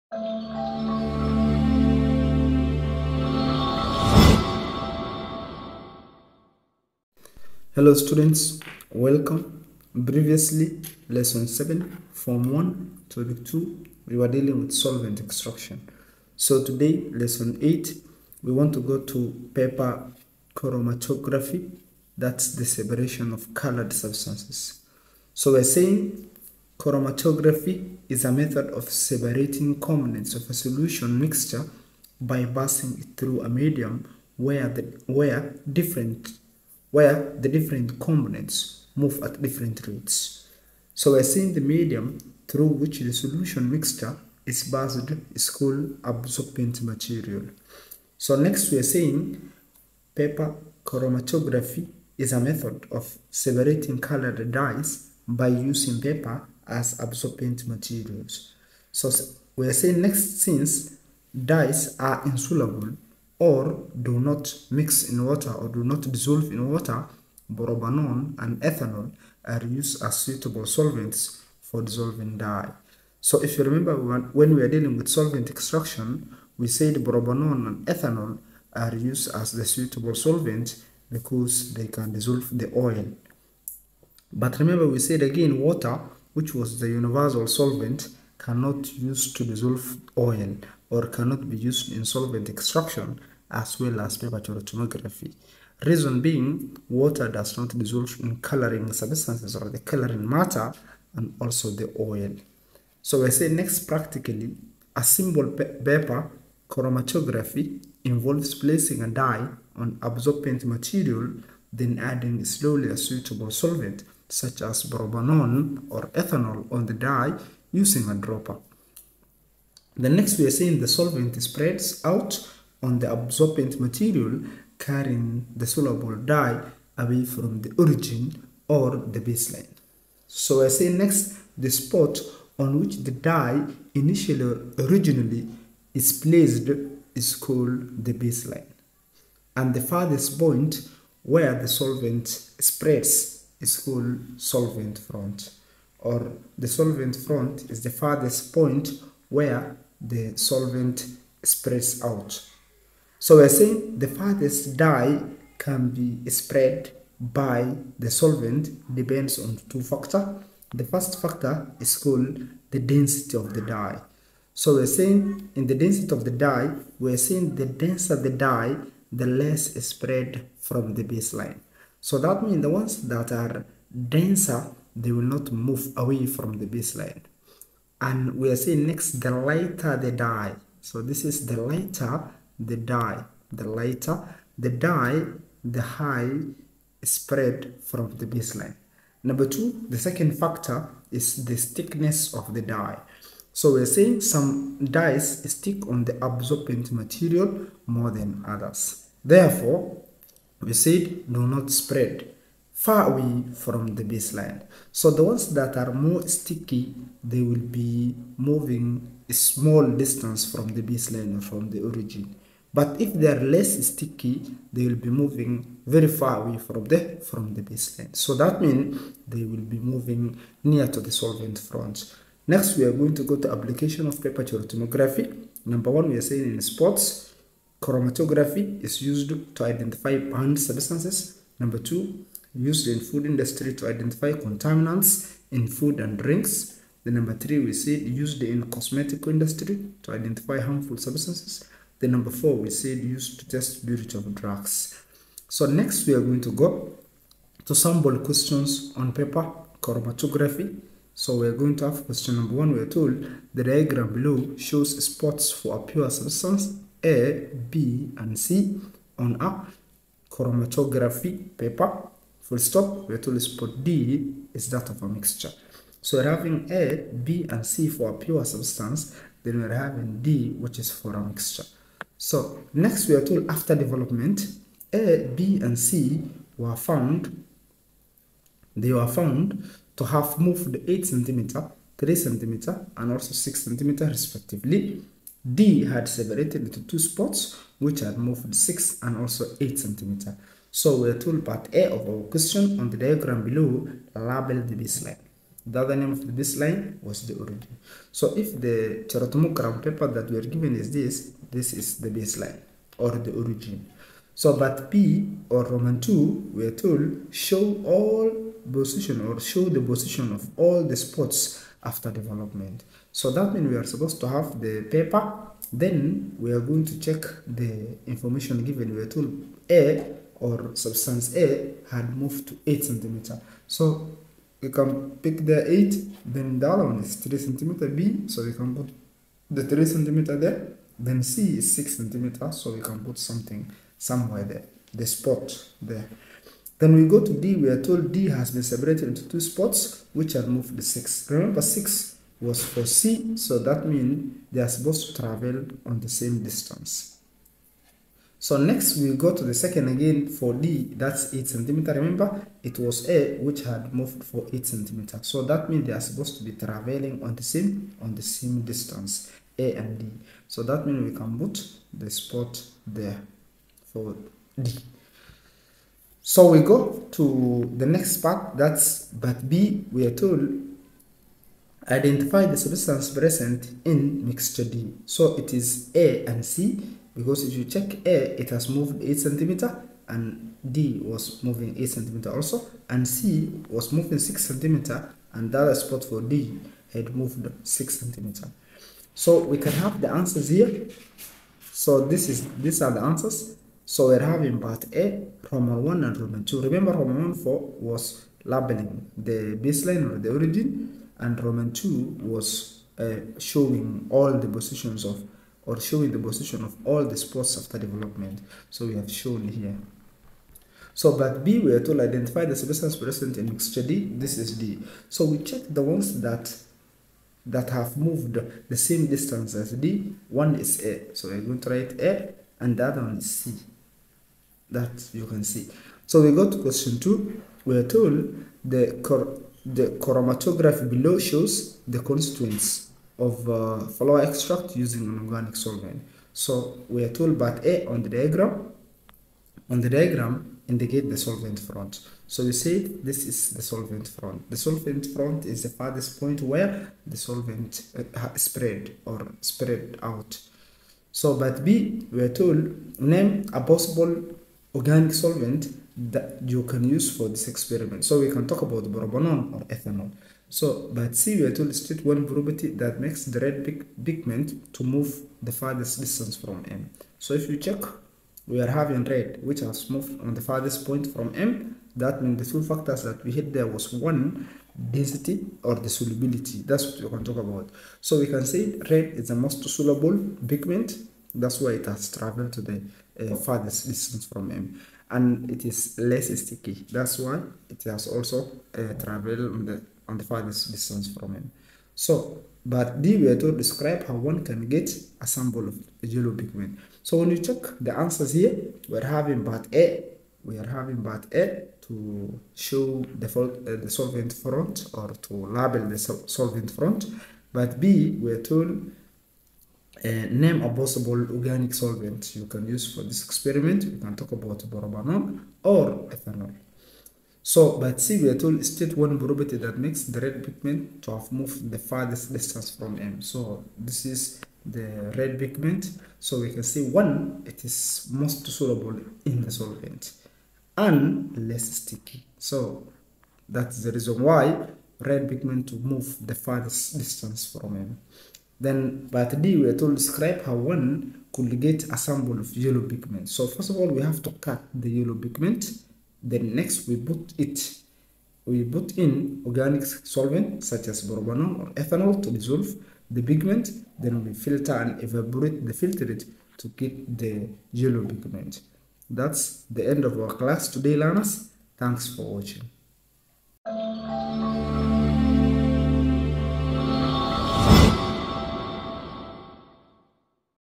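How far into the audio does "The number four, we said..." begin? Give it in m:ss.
4:01.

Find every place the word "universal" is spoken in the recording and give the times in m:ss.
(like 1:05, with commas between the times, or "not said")
1:26.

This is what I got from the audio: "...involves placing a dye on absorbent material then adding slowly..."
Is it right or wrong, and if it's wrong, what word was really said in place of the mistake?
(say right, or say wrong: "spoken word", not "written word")
right.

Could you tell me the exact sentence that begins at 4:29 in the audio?
Then we're having D, which is for a mixture.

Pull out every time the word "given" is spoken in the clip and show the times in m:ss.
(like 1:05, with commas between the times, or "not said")
5:00, 5:18.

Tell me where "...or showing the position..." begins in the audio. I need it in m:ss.
6:45.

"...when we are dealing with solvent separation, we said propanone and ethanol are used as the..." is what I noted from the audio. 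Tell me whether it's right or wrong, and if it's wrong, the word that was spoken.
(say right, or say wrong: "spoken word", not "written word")
wrong: "extraction", not "separation".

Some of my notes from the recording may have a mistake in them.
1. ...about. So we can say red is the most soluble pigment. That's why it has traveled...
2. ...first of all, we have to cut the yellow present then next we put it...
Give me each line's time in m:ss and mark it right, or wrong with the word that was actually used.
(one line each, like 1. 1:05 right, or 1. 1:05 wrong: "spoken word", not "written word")
1. 7:57 right
2. 9:03 wrong: "pigment", not "present".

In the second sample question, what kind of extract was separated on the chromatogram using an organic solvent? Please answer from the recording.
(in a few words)
flower extract.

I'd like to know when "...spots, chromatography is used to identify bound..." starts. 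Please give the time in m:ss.
3:46.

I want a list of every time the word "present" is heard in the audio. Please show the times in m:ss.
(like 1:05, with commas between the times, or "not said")
6:13, 6:52.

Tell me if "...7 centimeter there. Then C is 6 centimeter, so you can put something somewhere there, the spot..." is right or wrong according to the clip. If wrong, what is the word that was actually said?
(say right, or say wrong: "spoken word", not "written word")
wrong: "3", not "7".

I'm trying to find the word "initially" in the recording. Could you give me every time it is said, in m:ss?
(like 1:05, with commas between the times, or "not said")
2:13.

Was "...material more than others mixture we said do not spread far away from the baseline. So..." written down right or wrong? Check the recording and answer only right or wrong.
wrong.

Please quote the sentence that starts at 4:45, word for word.
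D had separated into two spots, which had moved 6 and also 8 centimeter.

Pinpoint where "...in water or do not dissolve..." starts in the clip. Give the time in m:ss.
1:05.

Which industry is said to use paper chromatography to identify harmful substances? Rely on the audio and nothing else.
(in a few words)
cosmetic industry.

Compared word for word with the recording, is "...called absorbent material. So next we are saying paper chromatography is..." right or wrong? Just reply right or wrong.
right.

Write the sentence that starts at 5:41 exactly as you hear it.
Remember 6 was for C, so that means they are supposed to travel on the same distance.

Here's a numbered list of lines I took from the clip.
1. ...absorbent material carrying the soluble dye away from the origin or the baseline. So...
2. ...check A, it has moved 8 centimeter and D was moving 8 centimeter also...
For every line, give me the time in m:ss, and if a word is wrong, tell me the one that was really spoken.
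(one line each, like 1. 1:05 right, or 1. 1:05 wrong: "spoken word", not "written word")
1. 2:03 right
2. 6:17 right.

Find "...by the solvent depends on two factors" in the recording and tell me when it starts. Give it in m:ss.
2:37.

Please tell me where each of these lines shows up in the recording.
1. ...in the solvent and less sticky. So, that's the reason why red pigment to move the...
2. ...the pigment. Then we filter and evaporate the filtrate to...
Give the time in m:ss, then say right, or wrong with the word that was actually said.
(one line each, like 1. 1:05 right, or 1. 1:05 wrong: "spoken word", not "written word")
1. 8:49 right
2. 9:13 right.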